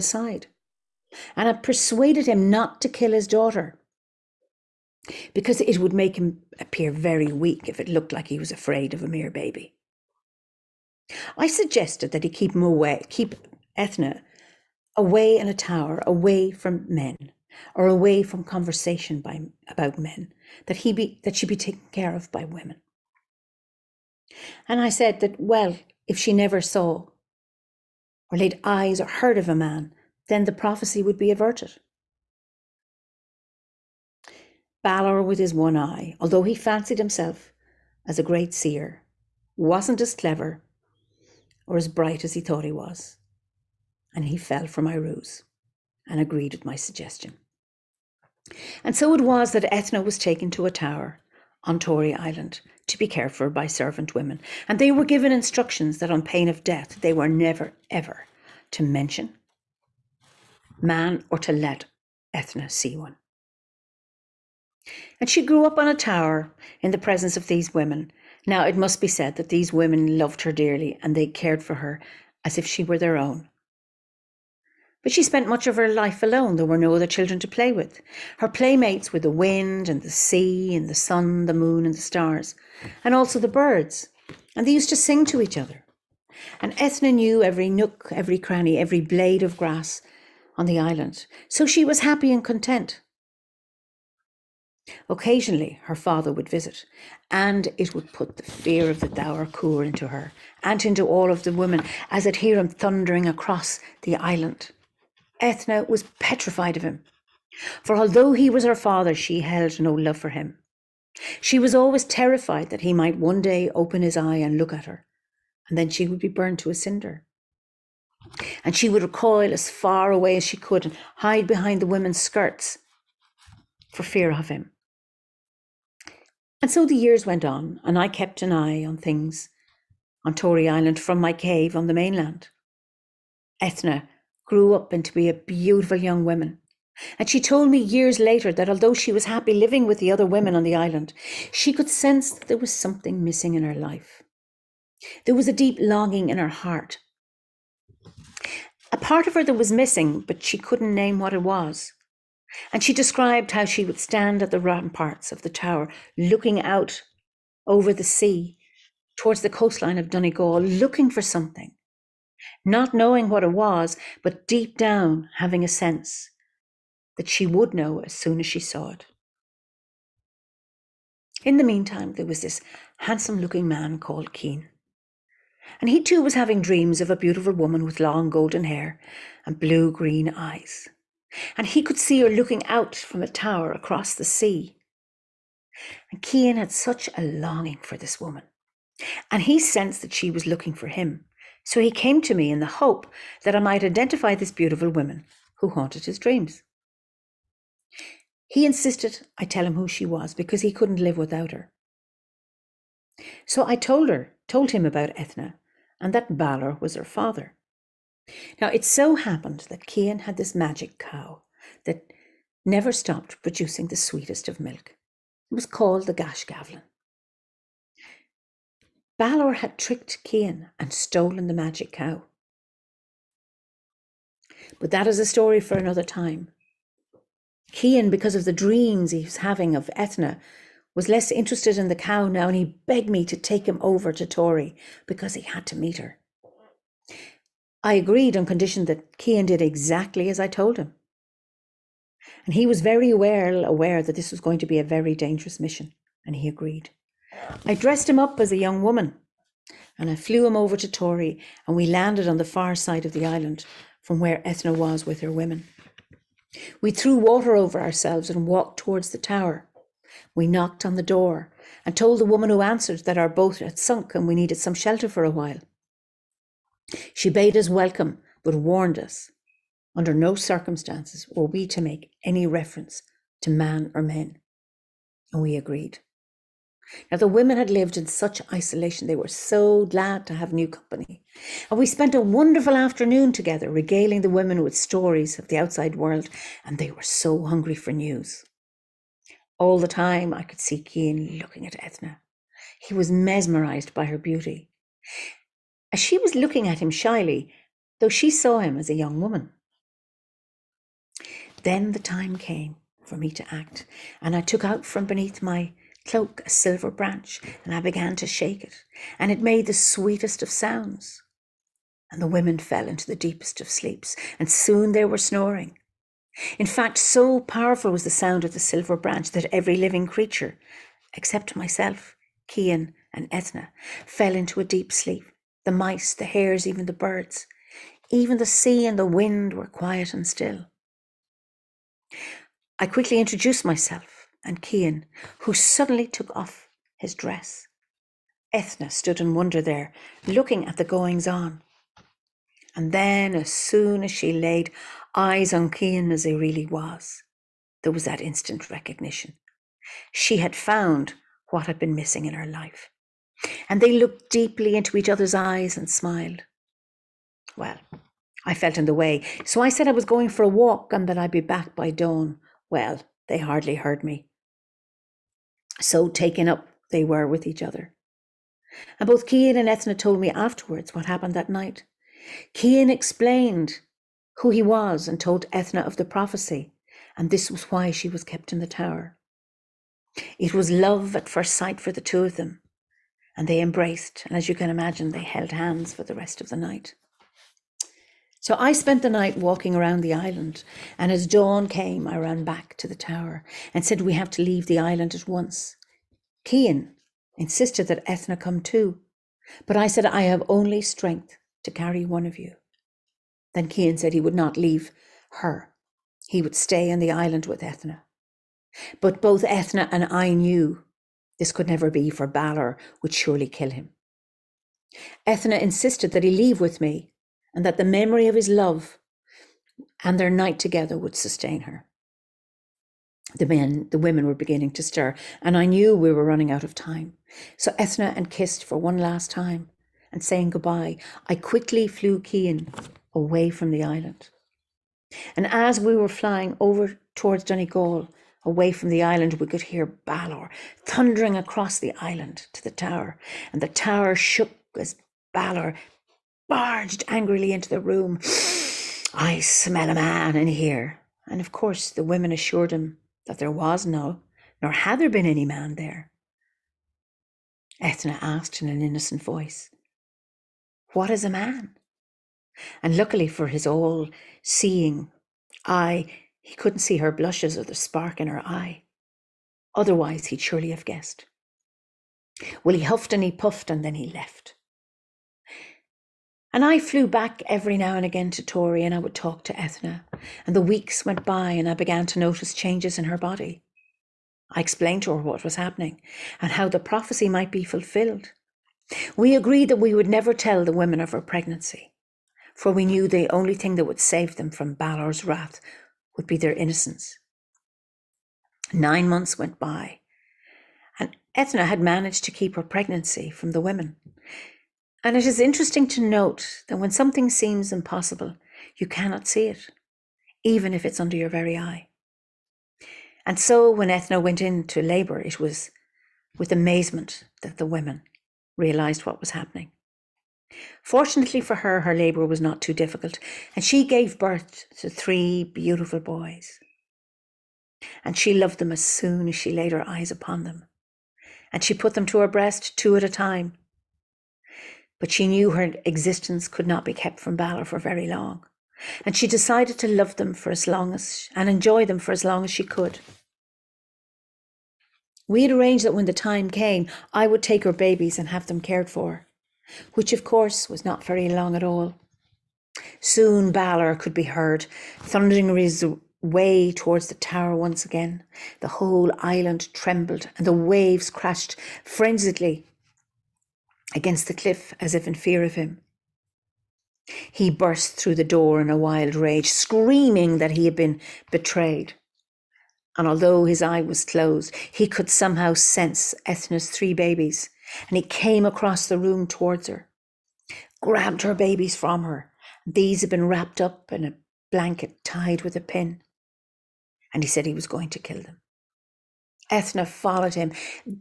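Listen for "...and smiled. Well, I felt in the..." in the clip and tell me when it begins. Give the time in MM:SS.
05:55.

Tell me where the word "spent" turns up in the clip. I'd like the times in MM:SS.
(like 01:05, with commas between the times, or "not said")
01:15, 04:41, 06:28.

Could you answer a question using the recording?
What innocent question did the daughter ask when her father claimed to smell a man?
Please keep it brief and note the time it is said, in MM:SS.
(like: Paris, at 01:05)
What is a man?, at 07:40.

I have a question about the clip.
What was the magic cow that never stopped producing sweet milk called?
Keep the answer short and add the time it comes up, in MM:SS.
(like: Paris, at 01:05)
Gashgavlin, at 03:36.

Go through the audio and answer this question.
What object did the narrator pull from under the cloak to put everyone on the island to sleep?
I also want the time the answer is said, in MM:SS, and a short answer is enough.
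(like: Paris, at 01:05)
A silver branch, at 05:06.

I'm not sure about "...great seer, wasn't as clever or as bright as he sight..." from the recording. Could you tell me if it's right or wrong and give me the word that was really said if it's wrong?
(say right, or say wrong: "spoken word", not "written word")
wrong: "thought", not "sight".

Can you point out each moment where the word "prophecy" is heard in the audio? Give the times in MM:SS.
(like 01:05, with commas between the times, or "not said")
00:30, 06:16, 08:06.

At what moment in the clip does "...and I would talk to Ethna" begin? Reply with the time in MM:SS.
07:58.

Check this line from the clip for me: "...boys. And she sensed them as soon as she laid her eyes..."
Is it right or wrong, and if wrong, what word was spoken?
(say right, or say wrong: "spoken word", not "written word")
wrong: "loved", not "sensed".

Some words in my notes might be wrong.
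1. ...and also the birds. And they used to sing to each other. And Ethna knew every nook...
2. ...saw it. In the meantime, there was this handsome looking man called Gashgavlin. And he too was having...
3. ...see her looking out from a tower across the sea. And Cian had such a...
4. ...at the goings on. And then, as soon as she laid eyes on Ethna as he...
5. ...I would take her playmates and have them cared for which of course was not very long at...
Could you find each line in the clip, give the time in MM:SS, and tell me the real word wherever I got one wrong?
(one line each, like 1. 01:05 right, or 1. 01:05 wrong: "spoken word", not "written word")
1. 01:23 right
2. 02:48 wrong: "Cian", not "Gashgavlin"
3. 03:01 right
4. 05:40 wrong: "Cian", not "Ethna"
5. 09:07 wrong: "babies", not "playmates".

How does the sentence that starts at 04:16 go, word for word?
We threw water over ourselves and walked towards the tower.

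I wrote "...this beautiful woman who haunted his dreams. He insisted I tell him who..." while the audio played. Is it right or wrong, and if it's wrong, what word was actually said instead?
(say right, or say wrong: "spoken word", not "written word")
right.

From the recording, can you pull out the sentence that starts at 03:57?
I agreed on condition that Cian did exactly as I told him.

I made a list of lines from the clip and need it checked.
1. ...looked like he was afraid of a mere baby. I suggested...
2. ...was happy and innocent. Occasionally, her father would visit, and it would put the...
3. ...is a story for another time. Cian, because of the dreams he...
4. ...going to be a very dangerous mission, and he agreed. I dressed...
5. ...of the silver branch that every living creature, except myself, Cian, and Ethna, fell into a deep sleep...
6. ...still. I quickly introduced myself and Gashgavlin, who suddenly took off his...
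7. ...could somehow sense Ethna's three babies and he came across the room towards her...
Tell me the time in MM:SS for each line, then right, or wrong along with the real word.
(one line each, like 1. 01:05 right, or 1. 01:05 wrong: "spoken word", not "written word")
1. 00:07 right
2. 01:31 wrong: "content", not "innocent"
3. 03:45 right
4. 04:04 right
5. 05:18 right
6. 05:30 wrong: "Cian", not "Gashgavlin"
7. 09:34 right.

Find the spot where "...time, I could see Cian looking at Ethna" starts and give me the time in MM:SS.
04:49.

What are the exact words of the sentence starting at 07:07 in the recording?
So Ethna and kissed for one last time, and saying goodbye, I quickly flew Cian away from the island.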